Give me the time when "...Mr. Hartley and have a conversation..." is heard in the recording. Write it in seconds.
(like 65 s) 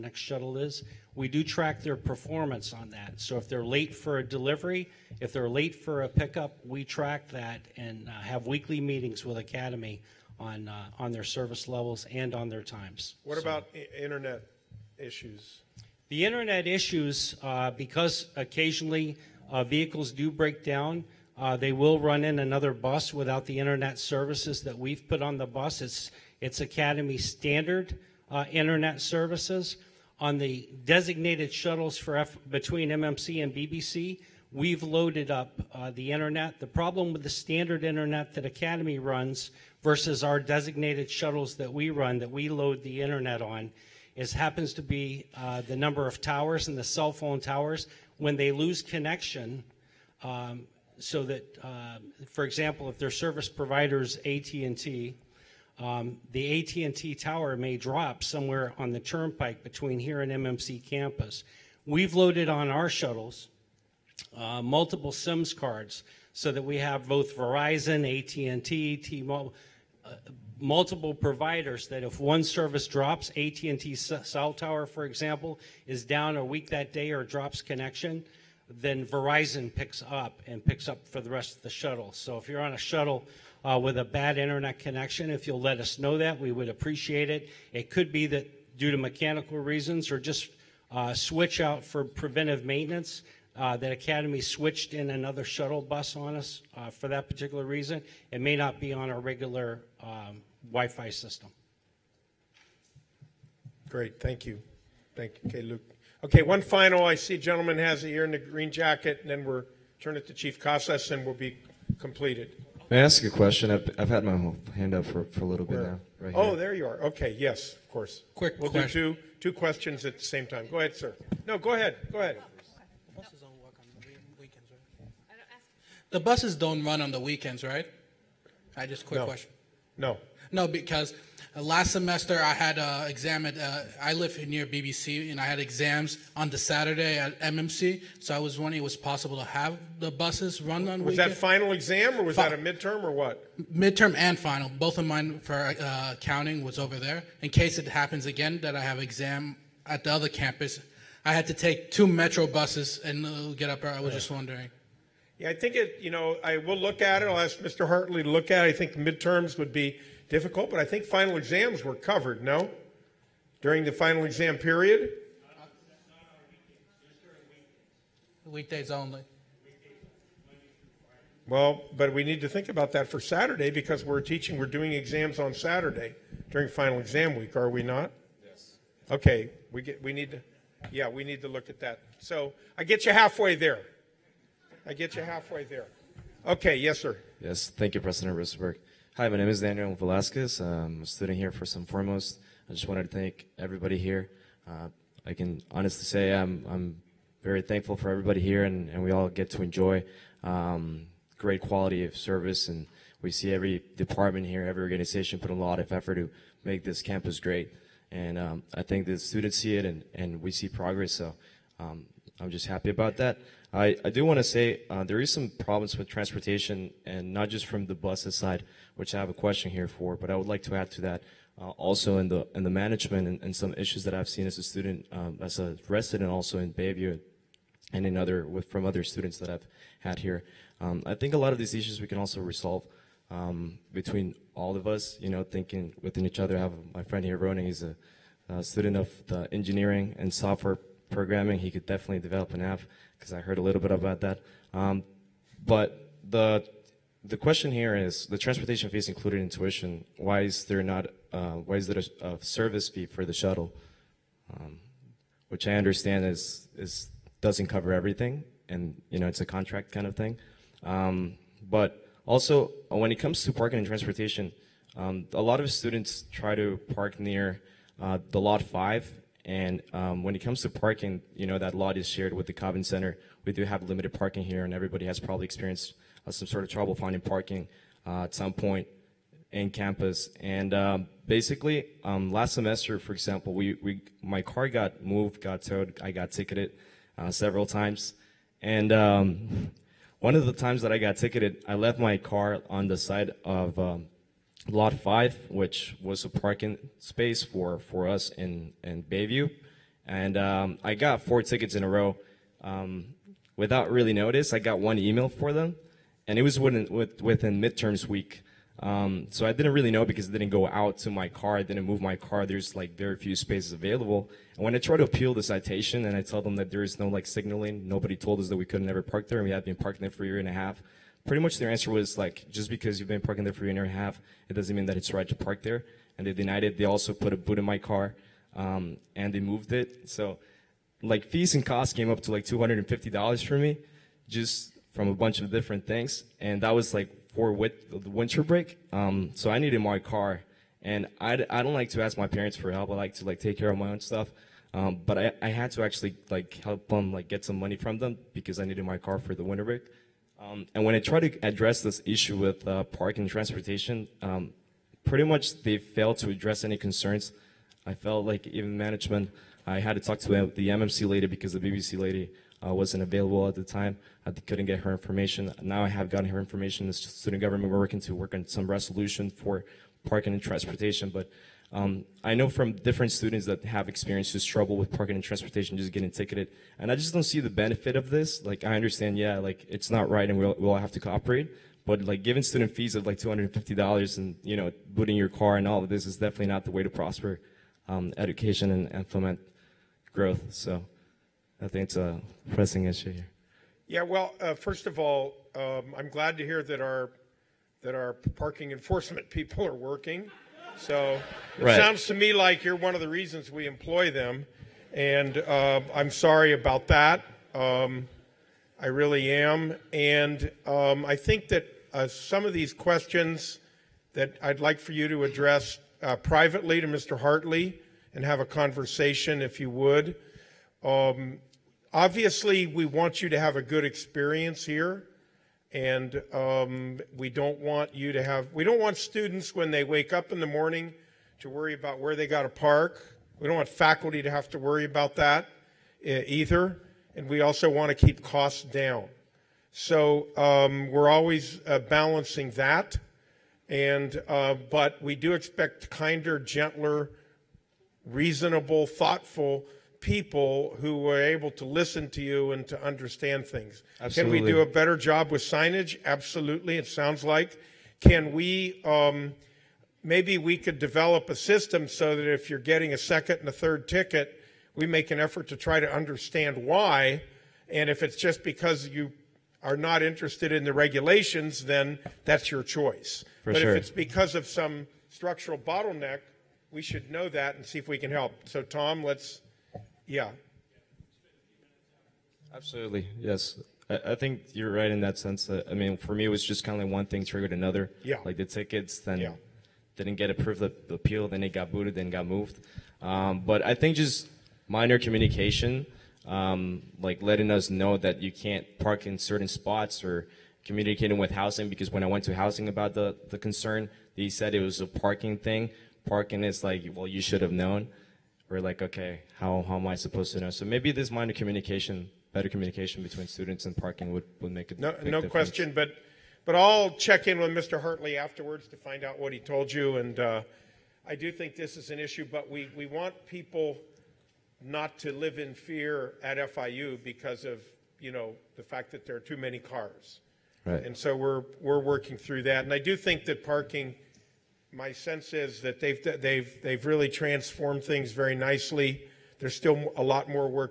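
416 s.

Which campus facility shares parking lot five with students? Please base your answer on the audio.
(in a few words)
Kovens Center.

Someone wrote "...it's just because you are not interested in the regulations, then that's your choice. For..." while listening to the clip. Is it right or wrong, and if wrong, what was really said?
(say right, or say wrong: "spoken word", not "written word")
right.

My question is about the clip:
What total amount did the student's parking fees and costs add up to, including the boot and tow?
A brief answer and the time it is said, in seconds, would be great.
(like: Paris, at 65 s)
$250, at 332 s.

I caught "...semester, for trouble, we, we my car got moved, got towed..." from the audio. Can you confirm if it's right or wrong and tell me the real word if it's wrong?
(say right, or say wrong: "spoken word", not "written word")
wrong: "example", not "trouble".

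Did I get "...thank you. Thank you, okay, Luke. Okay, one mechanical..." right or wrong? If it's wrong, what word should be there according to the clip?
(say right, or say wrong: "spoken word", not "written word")
wrong: "final", not "mechanical".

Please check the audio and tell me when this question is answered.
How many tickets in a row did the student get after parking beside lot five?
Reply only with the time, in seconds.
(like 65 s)
301 s.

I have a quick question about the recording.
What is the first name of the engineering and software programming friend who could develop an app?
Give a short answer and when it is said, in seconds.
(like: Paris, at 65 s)
Ronan, at 237 s.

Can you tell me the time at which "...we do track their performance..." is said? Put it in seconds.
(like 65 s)
1 s.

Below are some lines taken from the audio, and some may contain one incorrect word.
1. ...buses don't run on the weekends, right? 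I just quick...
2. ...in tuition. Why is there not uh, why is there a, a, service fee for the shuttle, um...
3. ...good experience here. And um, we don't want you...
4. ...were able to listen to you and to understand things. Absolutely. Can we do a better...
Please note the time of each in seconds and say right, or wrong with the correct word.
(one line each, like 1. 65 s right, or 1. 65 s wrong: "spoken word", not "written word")
1. 126 s right
2. 249 s right
3. 423 s right
4. 450 s right.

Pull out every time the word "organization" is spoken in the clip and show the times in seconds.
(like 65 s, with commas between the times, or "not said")
204 s.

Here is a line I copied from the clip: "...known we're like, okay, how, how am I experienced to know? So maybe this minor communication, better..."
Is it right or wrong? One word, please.
wrong.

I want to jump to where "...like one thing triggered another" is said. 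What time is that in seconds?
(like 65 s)
486 s.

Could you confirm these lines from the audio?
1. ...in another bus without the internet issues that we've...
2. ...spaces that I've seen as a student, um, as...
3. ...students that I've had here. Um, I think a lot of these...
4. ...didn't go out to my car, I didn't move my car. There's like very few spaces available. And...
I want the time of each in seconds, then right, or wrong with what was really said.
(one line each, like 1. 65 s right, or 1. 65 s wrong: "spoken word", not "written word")
1. 22 s wrong: "services", not "issues"
2. 223 s wrong: "issues", not "spaces"
3. 229 s right
4. 310 s right.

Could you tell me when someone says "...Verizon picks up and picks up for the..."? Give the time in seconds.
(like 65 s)
79 s.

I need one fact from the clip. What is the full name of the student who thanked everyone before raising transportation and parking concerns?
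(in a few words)
Daniel Velasquez.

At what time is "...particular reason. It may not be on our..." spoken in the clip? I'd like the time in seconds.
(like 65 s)
97 s.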